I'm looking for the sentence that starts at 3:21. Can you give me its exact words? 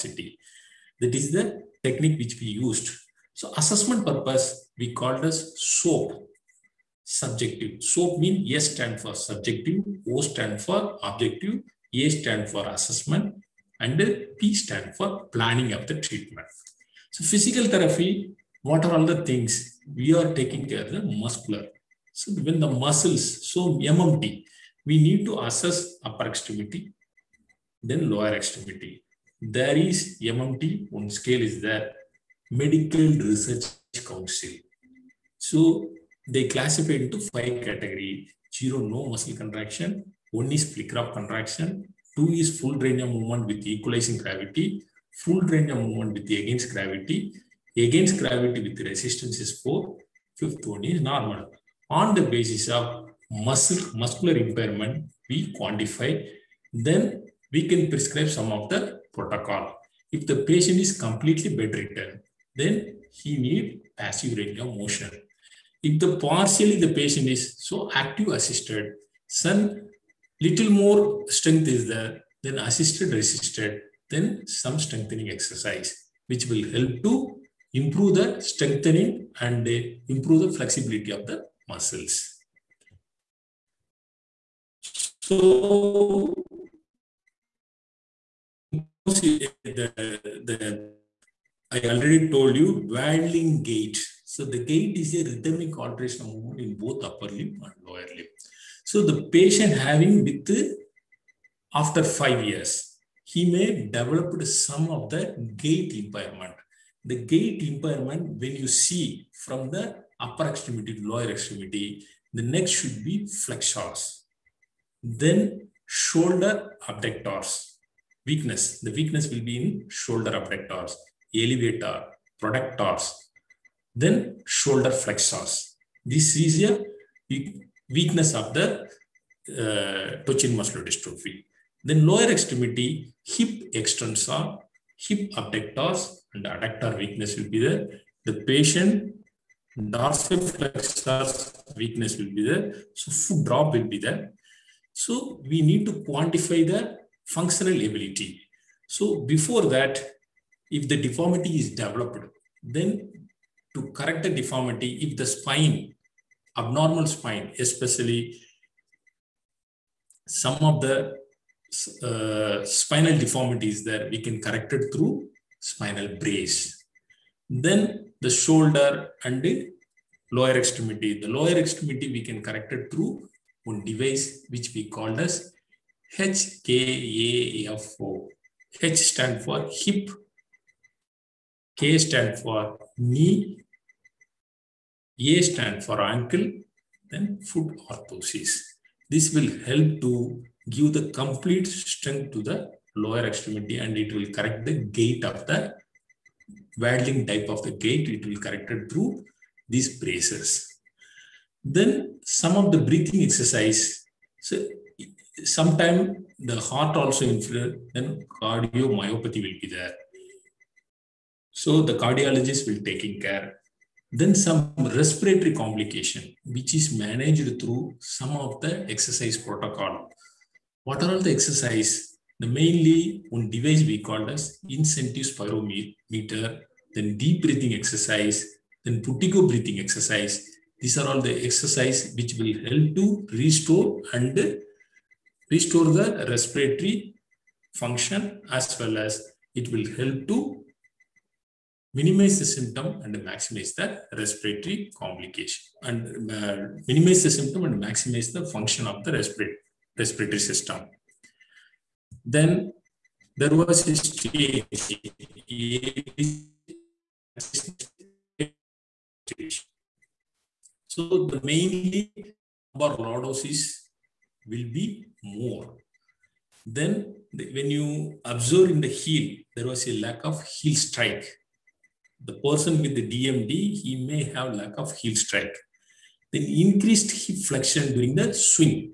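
Then some of the breathing exercise.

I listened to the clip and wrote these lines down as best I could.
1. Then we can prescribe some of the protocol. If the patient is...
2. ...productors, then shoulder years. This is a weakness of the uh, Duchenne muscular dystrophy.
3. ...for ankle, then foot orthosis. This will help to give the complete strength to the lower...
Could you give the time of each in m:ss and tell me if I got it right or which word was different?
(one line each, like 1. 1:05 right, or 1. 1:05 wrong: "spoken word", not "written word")
1. 0:56 right
2. 2:02 wrong: "flexors", not "years"
3. 3:05 right.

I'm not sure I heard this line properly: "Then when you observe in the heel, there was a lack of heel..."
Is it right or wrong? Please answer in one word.
right.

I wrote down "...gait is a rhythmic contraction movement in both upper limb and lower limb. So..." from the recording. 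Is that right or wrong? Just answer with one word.
right.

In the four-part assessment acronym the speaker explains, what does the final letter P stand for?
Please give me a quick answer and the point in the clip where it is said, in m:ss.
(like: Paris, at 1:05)
Planning, at 0:15.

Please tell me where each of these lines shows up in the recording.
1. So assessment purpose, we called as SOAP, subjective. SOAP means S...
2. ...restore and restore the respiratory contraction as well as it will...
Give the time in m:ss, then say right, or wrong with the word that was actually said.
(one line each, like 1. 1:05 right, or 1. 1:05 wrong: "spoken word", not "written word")
1. 0:03 right
2. 3:53 wrong: "function", not "contraction".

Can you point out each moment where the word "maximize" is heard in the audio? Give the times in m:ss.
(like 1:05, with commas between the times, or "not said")
4:03, 4:07.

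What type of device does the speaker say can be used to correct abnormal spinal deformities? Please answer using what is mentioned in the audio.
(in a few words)
Spinal brace.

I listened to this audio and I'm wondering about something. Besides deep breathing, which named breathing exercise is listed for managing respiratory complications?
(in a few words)
Buteyko breathing exercise.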